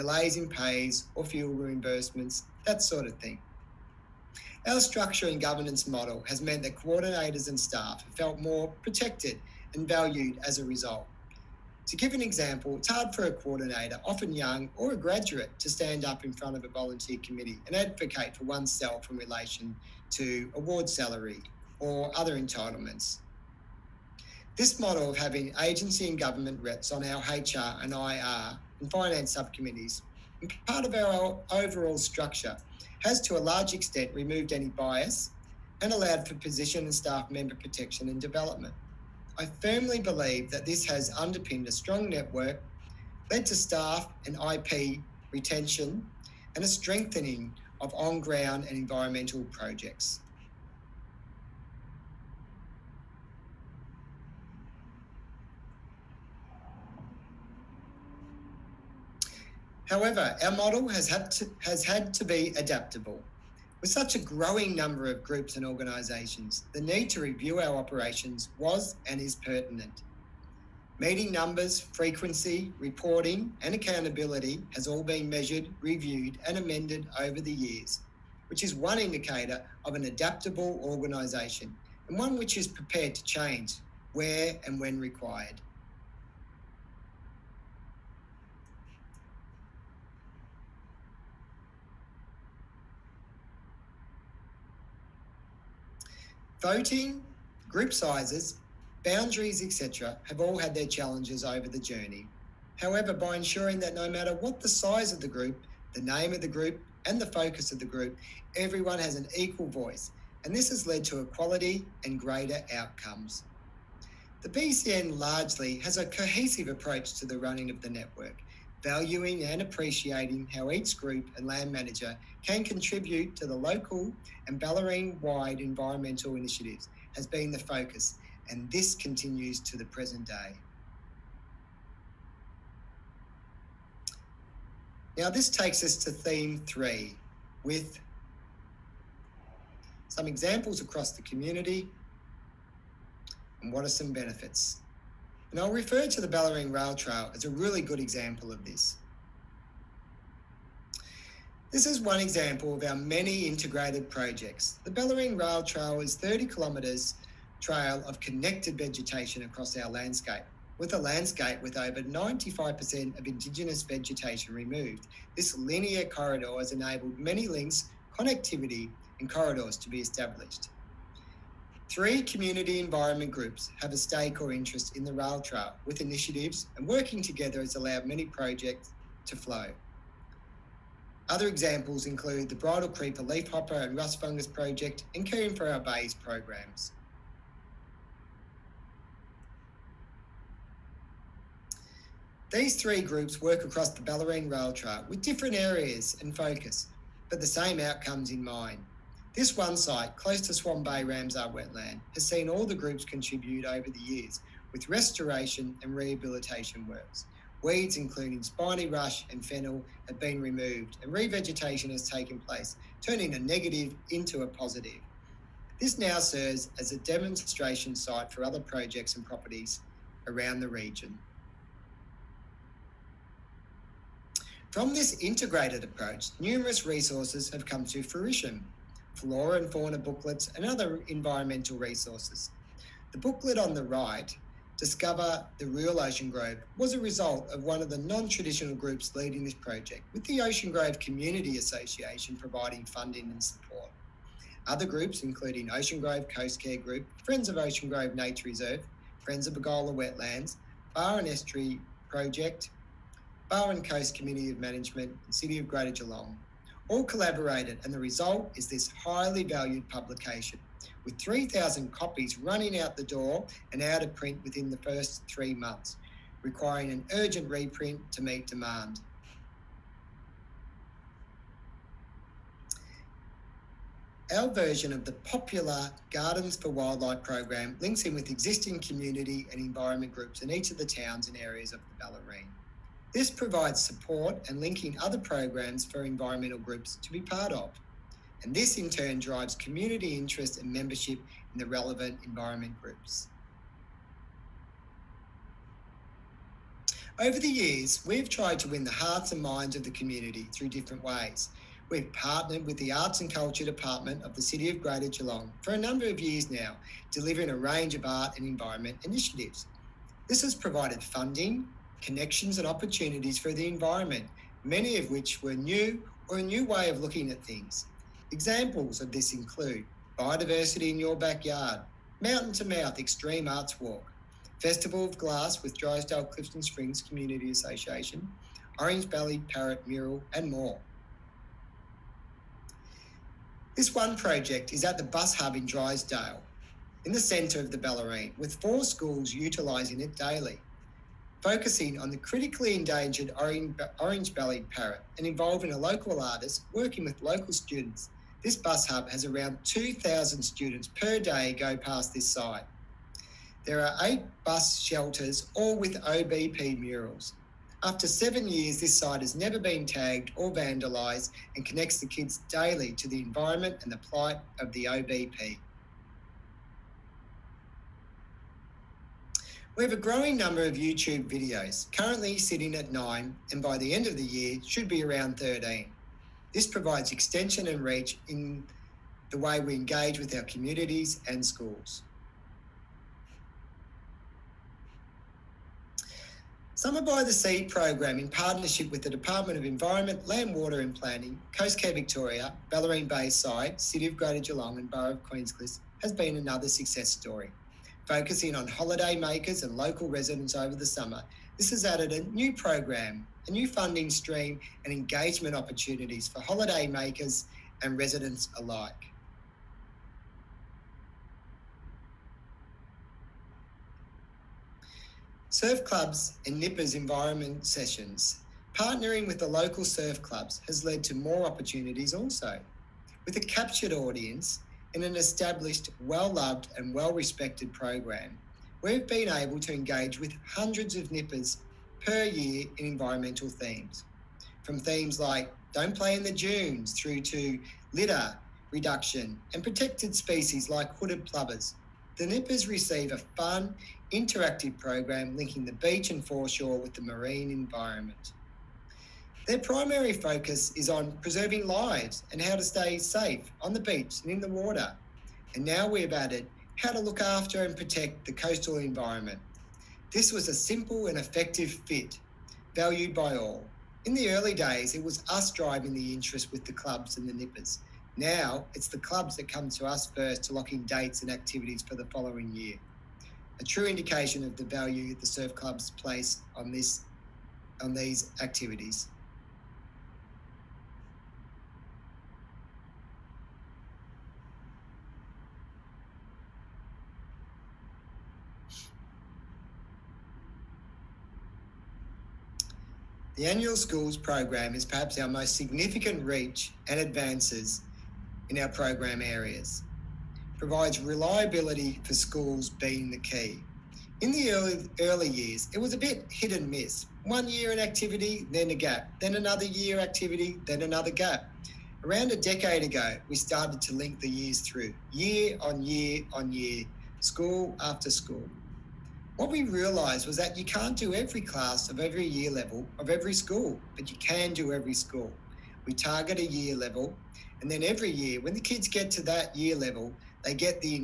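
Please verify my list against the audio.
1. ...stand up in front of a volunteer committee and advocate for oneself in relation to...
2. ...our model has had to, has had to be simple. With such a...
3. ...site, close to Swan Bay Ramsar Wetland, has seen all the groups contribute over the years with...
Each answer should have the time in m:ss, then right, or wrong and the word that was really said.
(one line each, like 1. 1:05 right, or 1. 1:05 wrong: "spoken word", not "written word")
1. 0:15 right
2. 1:00 wrong: "adaptable", not "simple"
3. 3:19 right.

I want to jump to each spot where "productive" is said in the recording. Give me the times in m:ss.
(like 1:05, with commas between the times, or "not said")
not said.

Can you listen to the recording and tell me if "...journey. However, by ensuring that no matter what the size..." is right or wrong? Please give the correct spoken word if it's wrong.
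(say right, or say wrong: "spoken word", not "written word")
right.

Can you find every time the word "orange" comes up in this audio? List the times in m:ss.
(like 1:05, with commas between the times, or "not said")
5:28, 5:44.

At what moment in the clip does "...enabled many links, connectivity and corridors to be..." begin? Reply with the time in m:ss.
2:46.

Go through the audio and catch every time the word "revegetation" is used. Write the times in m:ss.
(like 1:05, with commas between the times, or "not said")
3:31.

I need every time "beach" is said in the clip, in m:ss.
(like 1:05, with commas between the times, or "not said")
7:25, 7:33.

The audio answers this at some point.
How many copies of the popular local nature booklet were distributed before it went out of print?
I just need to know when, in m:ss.
4:21.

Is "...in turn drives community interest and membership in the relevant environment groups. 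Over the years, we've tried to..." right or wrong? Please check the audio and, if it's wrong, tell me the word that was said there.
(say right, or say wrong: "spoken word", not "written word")
right.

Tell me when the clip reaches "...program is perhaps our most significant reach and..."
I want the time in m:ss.
8:14.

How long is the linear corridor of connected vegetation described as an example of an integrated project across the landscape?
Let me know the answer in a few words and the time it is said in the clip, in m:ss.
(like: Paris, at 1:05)
30 kilometres, at 2:36.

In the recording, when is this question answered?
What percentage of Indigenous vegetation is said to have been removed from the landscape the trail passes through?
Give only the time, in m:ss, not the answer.
2:41.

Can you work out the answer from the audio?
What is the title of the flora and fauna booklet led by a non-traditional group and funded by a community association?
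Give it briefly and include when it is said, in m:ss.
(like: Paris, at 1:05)
Discover the Real Ocean Grove, at 3:54.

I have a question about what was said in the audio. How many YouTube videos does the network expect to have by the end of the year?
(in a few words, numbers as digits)
13.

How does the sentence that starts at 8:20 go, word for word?
Provides reliability for schools being the key.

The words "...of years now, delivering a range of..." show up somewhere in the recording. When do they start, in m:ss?
5:06.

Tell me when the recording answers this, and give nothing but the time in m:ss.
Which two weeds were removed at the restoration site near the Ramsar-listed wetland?
3:28.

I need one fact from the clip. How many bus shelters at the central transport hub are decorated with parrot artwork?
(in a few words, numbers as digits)
8.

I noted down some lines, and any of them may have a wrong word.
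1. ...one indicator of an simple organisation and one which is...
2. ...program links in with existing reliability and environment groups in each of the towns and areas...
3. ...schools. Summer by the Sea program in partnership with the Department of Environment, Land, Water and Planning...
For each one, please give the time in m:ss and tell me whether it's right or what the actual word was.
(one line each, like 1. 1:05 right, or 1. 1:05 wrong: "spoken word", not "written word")
1. 1:18 wrong: "adaptable", not "simple"
2. 4:37 wrong: "community", not "reliability"
3. 6:21 right.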